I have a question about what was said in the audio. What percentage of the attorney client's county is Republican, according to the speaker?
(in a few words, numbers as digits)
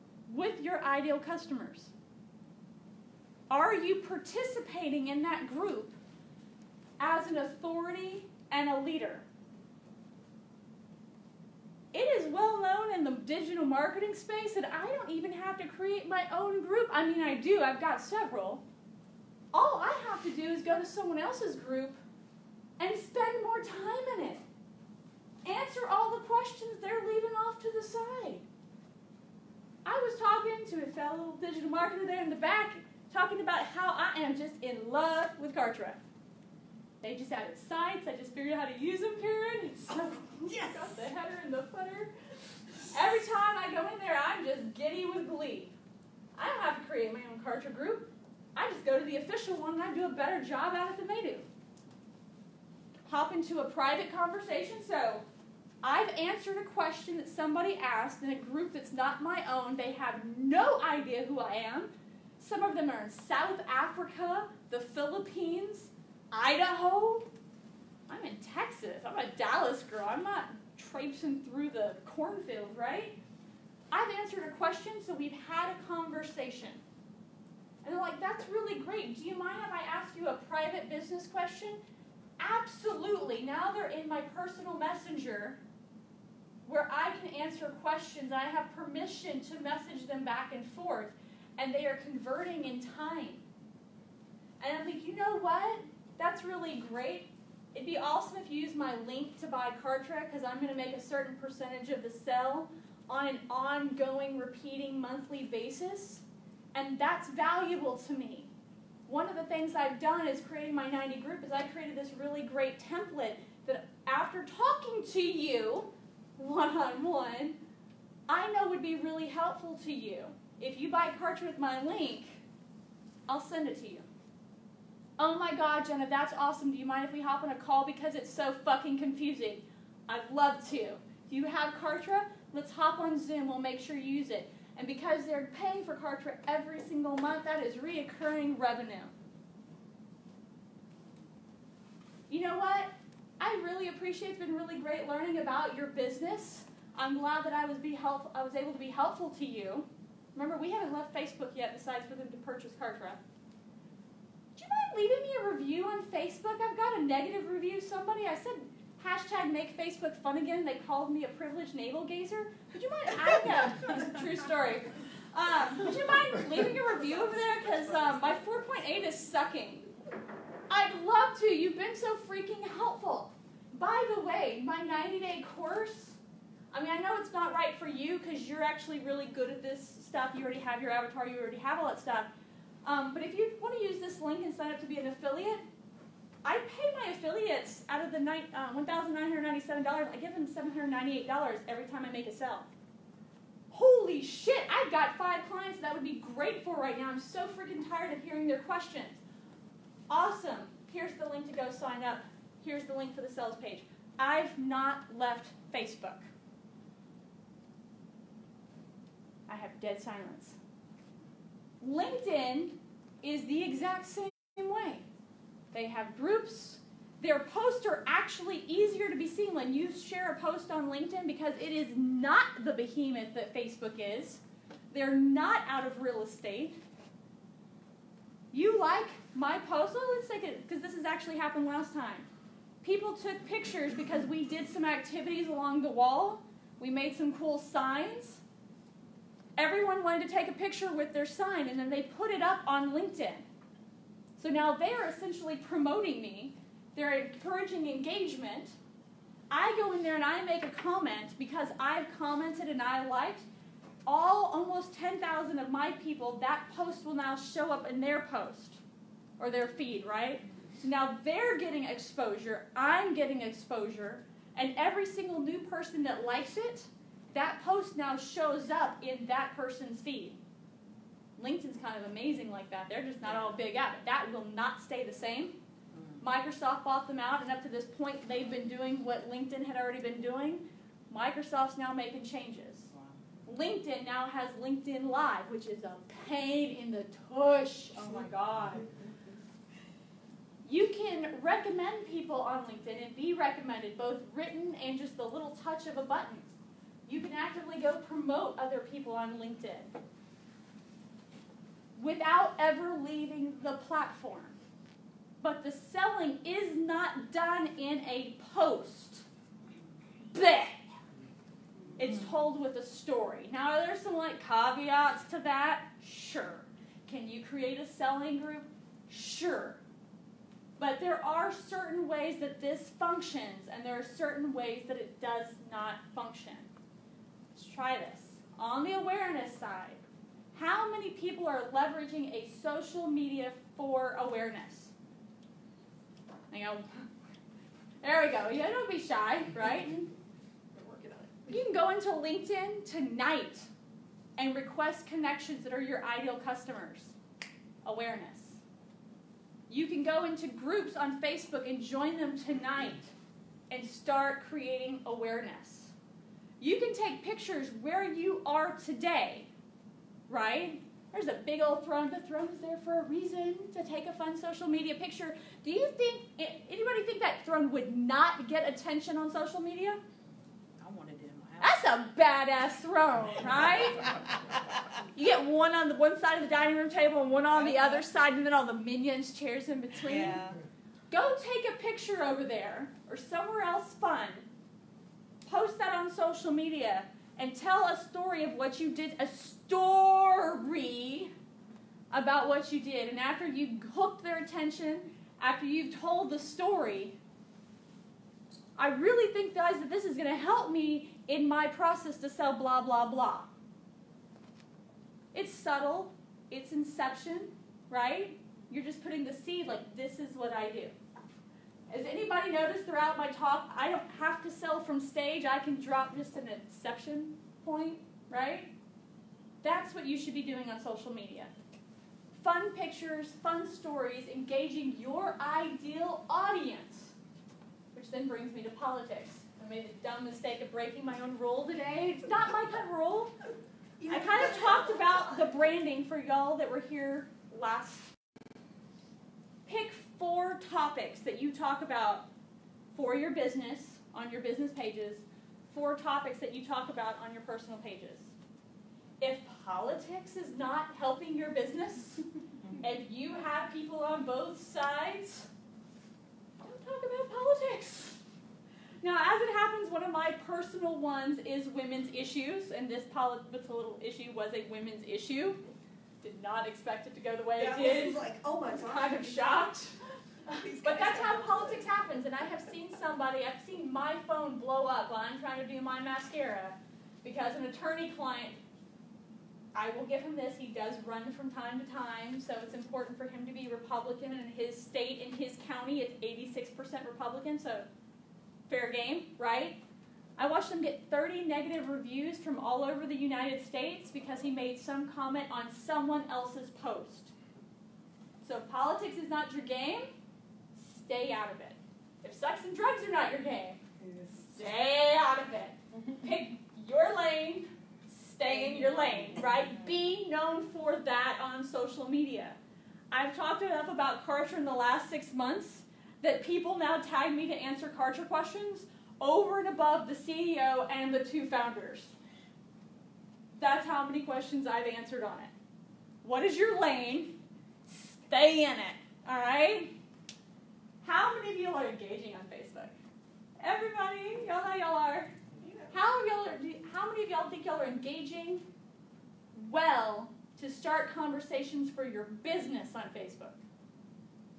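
86%.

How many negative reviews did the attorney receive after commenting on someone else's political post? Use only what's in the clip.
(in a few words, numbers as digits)
30.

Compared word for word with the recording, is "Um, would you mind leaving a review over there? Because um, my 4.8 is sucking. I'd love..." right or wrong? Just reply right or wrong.
right.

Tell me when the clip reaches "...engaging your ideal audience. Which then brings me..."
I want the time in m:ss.
7:04.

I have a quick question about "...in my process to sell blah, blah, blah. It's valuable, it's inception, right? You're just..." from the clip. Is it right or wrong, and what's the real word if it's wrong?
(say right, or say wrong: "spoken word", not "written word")
wrong: "subtle", not "valuable".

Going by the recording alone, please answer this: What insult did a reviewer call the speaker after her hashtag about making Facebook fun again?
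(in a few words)
privileged navel gazer.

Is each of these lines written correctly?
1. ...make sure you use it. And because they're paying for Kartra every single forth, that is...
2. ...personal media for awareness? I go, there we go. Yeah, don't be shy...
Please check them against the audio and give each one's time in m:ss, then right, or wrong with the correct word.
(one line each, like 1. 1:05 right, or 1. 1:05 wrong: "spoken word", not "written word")
1. 2:13 wrong: "month", not "forth"
2. 5:32 wrong: "social", not "personal".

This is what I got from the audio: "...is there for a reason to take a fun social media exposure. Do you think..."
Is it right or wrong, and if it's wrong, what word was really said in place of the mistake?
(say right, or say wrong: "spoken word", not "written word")
wrong: "picture", not "exposure".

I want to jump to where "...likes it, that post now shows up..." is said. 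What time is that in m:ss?
4:26.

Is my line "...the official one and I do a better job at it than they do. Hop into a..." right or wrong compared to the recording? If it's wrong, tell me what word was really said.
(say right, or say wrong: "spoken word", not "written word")
right.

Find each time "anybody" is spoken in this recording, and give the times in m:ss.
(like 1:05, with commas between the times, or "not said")
6:06, 6:52.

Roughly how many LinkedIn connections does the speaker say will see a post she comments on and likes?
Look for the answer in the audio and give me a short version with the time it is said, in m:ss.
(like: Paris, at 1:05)
10,000, at 4:14.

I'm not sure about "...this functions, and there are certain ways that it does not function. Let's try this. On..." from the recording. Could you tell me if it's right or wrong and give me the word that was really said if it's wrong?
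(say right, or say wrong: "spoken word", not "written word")
right.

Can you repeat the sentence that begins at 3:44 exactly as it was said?
They're not out of real estate.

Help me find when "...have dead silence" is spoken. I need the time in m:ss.
3:29.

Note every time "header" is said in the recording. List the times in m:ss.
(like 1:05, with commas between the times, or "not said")
0:41.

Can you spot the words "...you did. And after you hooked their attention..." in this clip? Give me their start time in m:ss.
6:32.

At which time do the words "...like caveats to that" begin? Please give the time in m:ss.
5:14.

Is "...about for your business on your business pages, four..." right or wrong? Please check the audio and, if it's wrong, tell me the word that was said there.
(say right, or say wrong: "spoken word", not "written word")
right.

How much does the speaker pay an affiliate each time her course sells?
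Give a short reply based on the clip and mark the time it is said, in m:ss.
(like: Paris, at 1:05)
$798, at 3:10.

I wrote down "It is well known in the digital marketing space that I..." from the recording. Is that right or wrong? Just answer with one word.
right.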